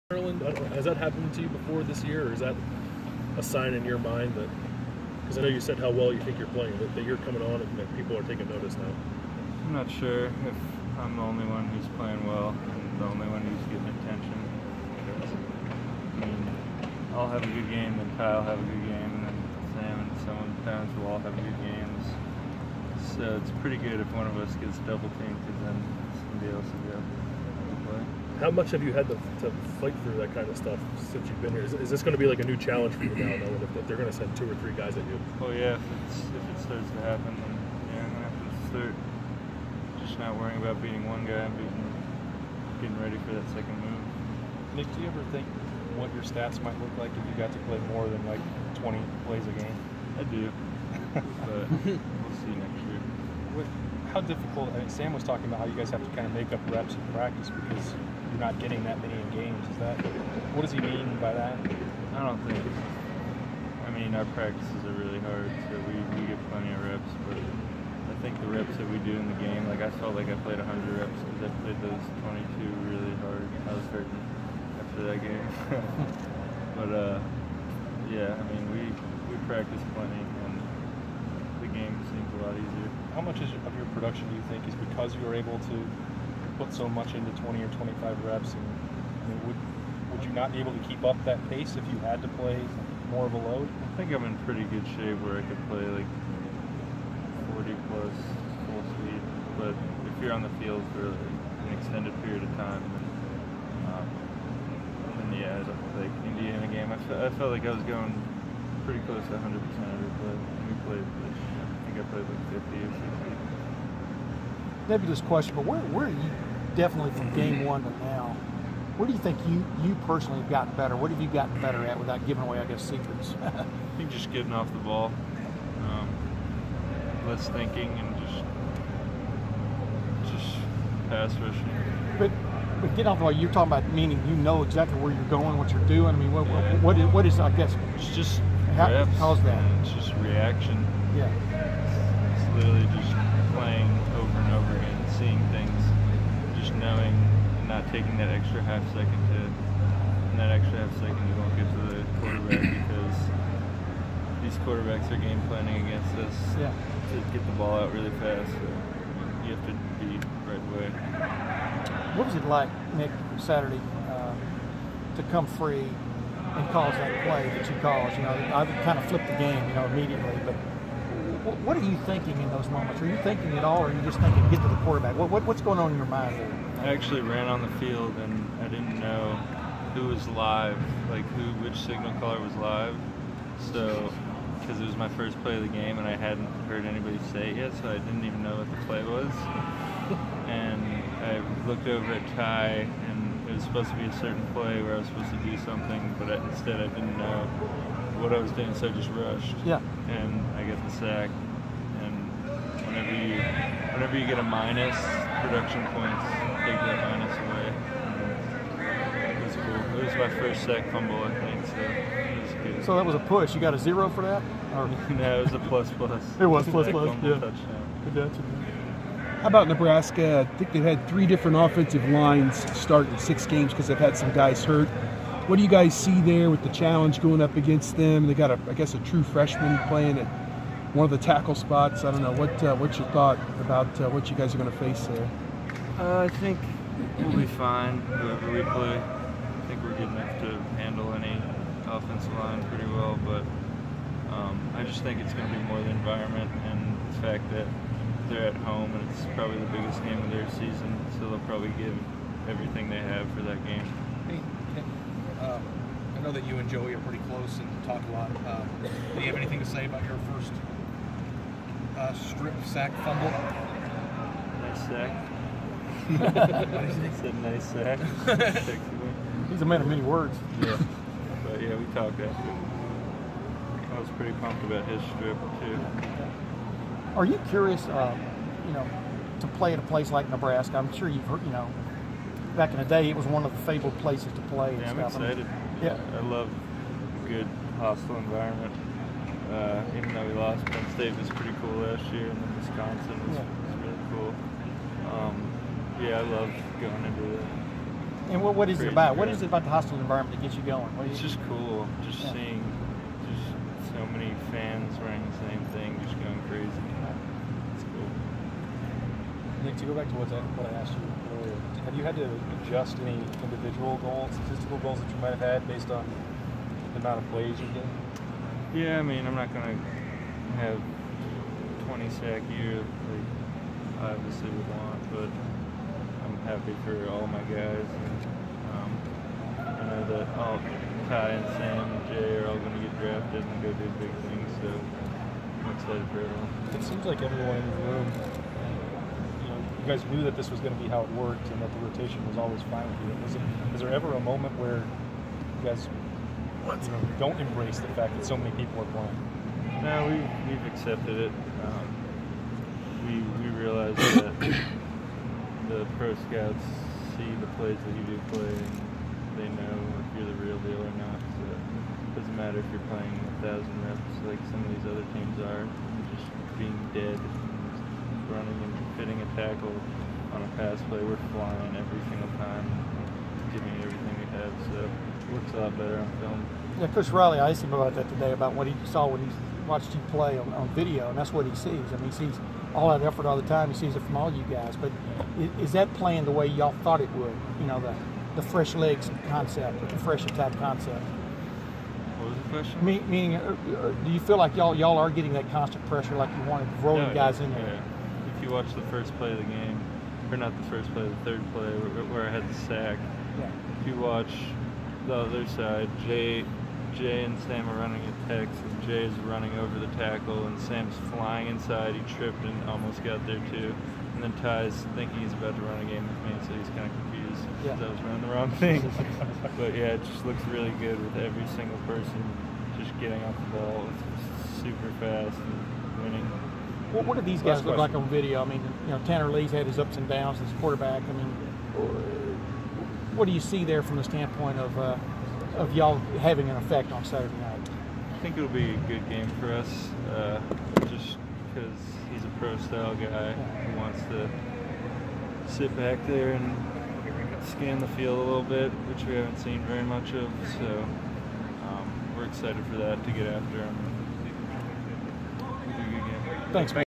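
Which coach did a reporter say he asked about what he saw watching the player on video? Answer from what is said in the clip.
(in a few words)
Coach Riley.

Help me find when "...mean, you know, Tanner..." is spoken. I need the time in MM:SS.
07:08.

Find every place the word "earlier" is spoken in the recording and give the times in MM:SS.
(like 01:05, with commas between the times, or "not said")
05:11.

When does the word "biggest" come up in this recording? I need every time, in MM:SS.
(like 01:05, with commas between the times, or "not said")
04:09.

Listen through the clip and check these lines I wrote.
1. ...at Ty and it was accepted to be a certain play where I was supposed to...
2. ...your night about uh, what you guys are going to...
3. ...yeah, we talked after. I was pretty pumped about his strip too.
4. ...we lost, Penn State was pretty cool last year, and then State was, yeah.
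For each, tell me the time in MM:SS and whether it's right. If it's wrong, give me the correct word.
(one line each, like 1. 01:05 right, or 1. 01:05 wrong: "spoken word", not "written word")
1. 03:12 wrong: "supposed", not "accepted"
2. 03:52 wrong: "thought", not "night"
3. 04:31 right
4. 04:50 wrong: "Wisconsin", not "State".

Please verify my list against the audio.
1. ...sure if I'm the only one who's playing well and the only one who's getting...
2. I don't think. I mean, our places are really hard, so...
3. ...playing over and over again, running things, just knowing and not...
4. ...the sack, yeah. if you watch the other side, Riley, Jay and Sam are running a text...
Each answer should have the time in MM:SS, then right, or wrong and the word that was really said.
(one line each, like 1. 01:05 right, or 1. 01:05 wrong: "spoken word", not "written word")
1. 00:09 right
2. 01:02 wrong: "practices", not "places"
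3. 02:23 wrong: "seeing", not "running"
4. 06:42 wrong: "Jay", not "Riley".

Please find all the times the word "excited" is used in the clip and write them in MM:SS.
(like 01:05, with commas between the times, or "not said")
04:45, 05:35, 07:32.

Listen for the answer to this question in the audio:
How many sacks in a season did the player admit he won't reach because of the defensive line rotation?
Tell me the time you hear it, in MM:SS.
05:21.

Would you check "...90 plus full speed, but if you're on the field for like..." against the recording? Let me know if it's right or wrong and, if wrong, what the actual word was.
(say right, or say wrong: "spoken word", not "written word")
wrong: "40", not "90".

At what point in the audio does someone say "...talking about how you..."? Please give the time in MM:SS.
00:55.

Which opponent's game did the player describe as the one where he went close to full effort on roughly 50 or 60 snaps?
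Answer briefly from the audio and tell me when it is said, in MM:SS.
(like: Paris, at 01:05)
Indiana, at 01:46.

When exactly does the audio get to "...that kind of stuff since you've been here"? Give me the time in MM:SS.
00:30.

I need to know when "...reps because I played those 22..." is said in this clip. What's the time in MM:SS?
01:10.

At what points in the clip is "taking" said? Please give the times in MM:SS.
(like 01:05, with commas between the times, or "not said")
00:08, 02:27.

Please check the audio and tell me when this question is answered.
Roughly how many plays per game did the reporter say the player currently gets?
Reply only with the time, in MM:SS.
00:48.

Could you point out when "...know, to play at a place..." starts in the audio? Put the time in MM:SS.
04:38.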